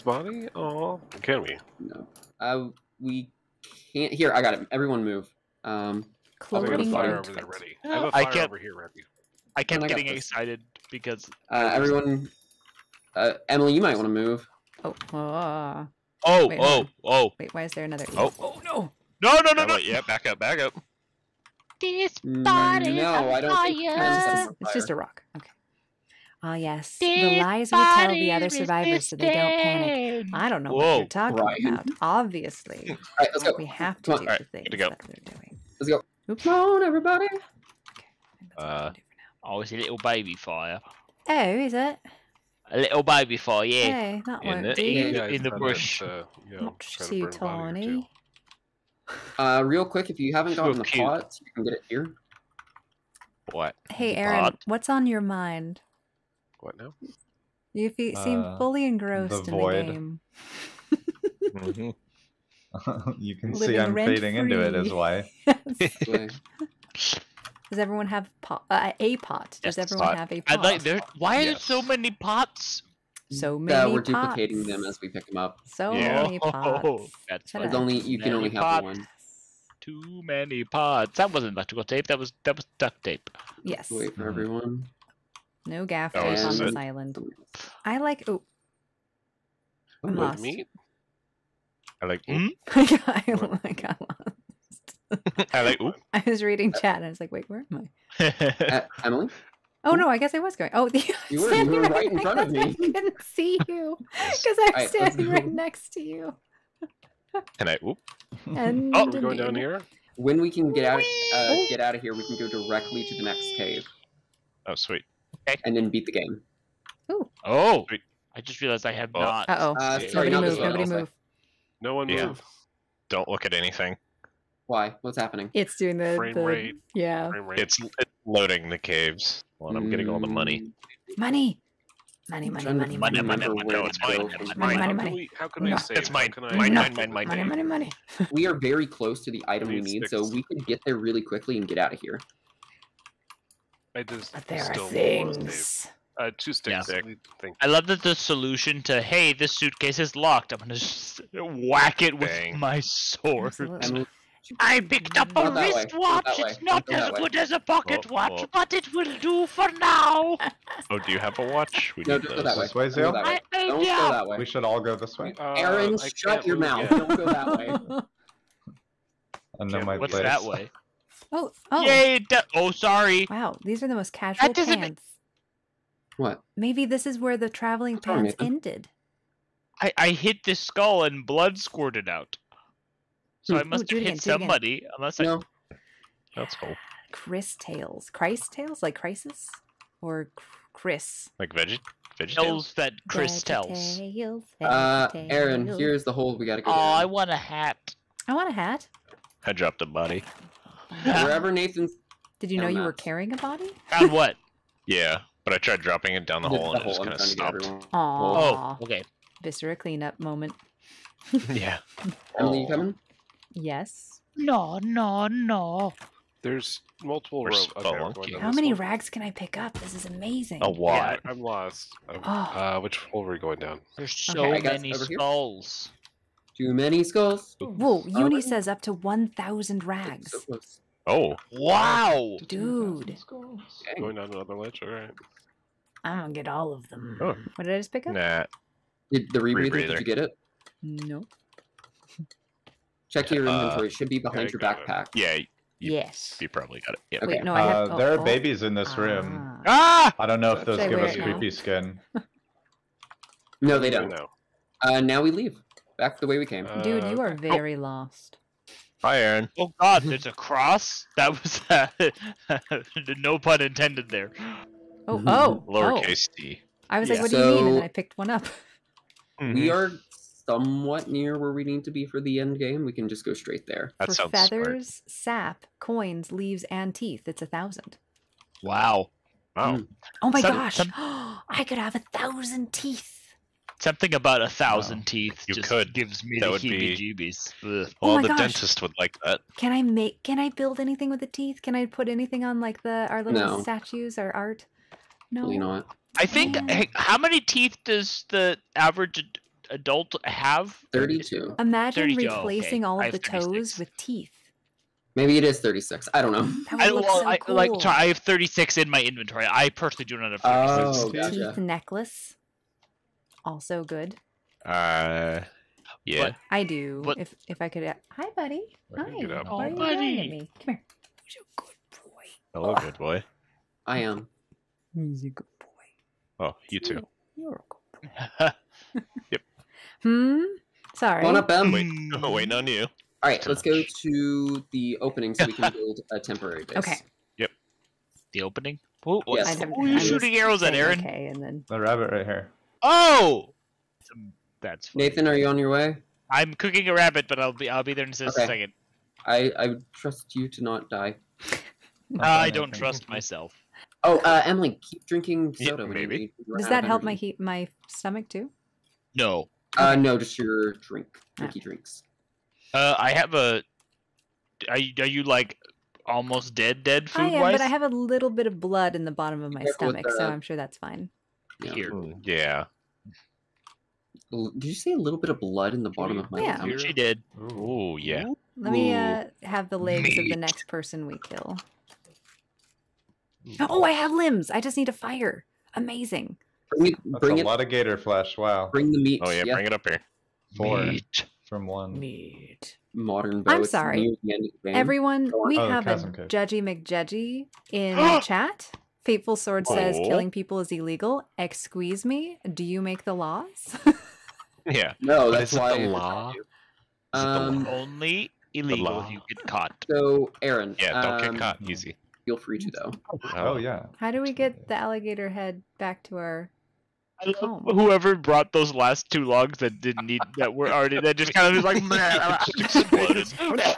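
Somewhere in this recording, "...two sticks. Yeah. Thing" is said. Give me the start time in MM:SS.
02:26.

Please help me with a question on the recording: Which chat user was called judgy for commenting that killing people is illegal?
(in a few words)
Fateful Sword.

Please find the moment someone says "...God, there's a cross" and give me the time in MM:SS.
04:19.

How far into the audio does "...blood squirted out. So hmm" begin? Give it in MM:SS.
03:01.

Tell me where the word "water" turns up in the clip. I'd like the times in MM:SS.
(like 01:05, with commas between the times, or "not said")
not said.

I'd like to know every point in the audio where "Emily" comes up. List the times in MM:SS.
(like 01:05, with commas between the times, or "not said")
00:13, 01:39, 03:32, 05:54.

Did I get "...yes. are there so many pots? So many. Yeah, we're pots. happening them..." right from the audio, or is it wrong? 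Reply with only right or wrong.
wrong.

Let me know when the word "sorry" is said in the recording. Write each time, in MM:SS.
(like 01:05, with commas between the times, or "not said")
02:00, 02:52, 05:07, 05:30, 06:33.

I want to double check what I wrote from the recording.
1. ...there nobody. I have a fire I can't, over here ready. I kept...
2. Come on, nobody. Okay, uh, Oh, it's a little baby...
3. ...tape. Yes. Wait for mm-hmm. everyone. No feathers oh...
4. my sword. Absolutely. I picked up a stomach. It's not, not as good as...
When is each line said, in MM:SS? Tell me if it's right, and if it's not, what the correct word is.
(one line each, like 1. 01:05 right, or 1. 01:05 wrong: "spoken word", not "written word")
1. 00:07 wrong: "ready", not "nobody"
2. 00:36 wrong: "everybody", not "nobody"
3. 01:23 wrong: "gaffers", not "feathers"
4. 02:32 wrong: "wristwatch", not "stomach".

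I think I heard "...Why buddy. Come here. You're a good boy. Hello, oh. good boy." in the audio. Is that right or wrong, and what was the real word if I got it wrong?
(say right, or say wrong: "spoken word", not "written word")
right.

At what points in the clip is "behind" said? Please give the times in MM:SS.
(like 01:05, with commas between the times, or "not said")
04:04.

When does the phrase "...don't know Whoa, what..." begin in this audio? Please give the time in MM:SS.
00:30.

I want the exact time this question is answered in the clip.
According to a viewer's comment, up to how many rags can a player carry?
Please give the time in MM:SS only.
03:48.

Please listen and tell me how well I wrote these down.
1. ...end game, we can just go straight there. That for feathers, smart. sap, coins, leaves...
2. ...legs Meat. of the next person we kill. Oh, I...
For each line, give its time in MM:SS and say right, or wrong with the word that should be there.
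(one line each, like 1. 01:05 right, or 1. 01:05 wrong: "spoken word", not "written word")
1. 04:32 right
2. 06:19 right.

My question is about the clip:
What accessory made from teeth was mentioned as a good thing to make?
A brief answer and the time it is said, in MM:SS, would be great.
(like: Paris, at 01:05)
Teeth necklace, at 05:11.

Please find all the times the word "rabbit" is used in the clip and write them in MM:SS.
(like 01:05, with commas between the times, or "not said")
05:41, 05:46.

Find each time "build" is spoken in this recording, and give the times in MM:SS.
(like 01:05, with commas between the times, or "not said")
04:50, 05:35.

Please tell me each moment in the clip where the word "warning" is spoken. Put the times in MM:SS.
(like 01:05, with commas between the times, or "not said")
not said.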